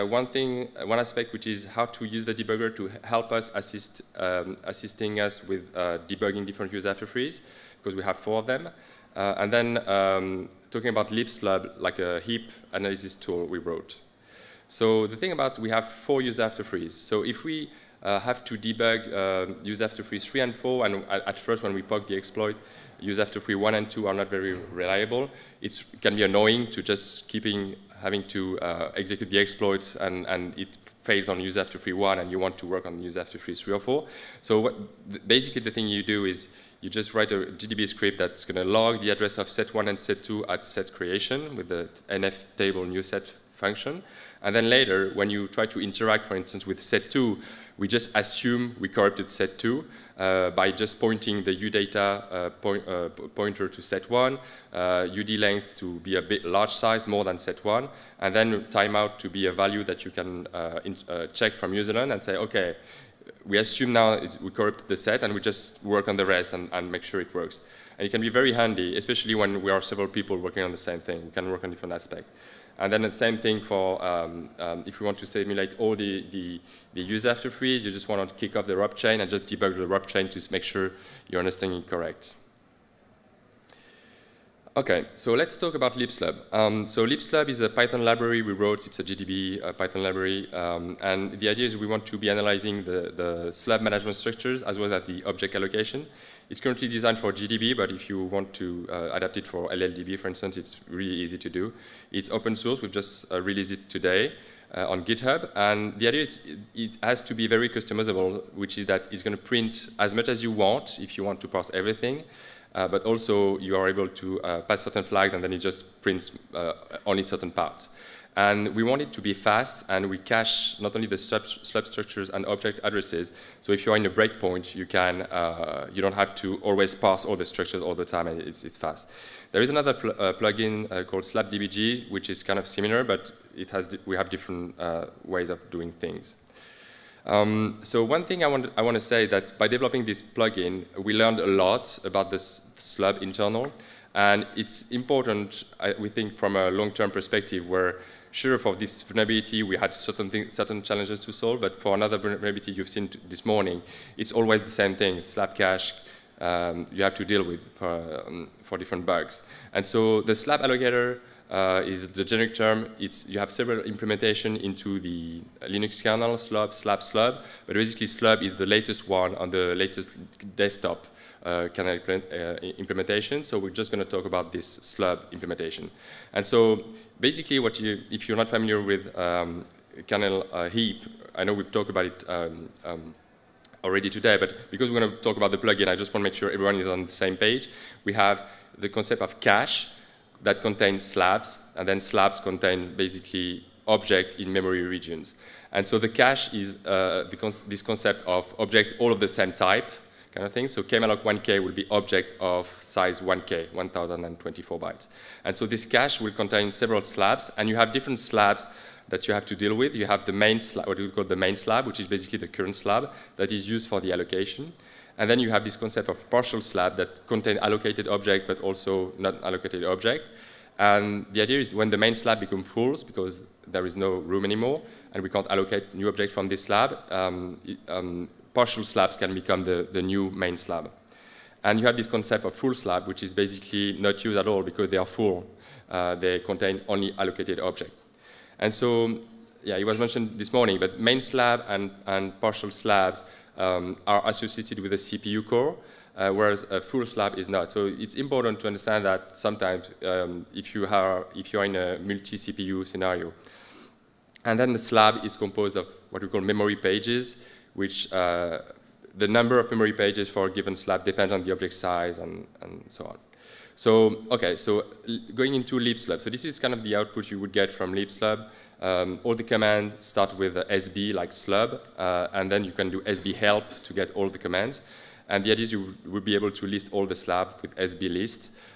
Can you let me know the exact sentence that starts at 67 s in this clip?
And it can be very handy, especially when we are several people working on the same thing.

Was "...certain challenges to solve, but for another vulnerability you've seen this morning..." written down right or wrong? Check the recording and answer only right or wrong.
right.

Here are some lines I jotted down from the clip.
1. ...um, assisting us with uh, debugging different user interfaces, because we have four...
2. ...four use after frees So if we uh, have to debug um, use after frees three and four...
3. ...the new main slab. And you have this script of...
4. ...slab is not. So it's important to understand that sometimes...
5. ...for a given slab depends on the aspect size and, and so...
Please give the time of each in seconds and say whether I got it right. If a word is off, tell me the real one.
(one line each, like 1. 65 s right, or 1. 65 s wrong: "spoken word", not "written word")
1. 4 s right
2. 15 s right
3. 229 s wrong: "concept", not "script"
4. 247 s right
5. 260 s wrong: "object", not "aspect".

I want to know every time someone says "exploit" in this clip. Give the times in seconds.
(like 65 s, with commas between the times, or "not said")
22 s, 29 s.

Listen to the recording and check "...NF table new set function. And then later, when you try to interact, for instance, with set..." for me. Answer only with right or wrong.
right.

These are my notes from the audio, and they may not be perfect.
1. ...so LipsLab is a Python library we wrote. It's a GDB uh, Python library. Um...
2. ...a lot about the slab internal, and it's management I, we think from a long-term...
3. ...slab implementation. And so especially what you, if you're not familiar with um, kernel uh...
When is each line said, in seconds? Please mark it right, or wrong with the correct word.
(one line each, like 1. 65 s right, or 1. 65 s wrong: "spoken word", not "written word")
1. 86 s right
2. 141 s wrong: "important", not "management"
3. 174 s wrong: "basically", not "especially".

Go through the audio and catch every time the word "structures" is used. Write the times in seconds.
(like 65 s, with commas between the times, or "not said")
94 s, 121 s, 127 s.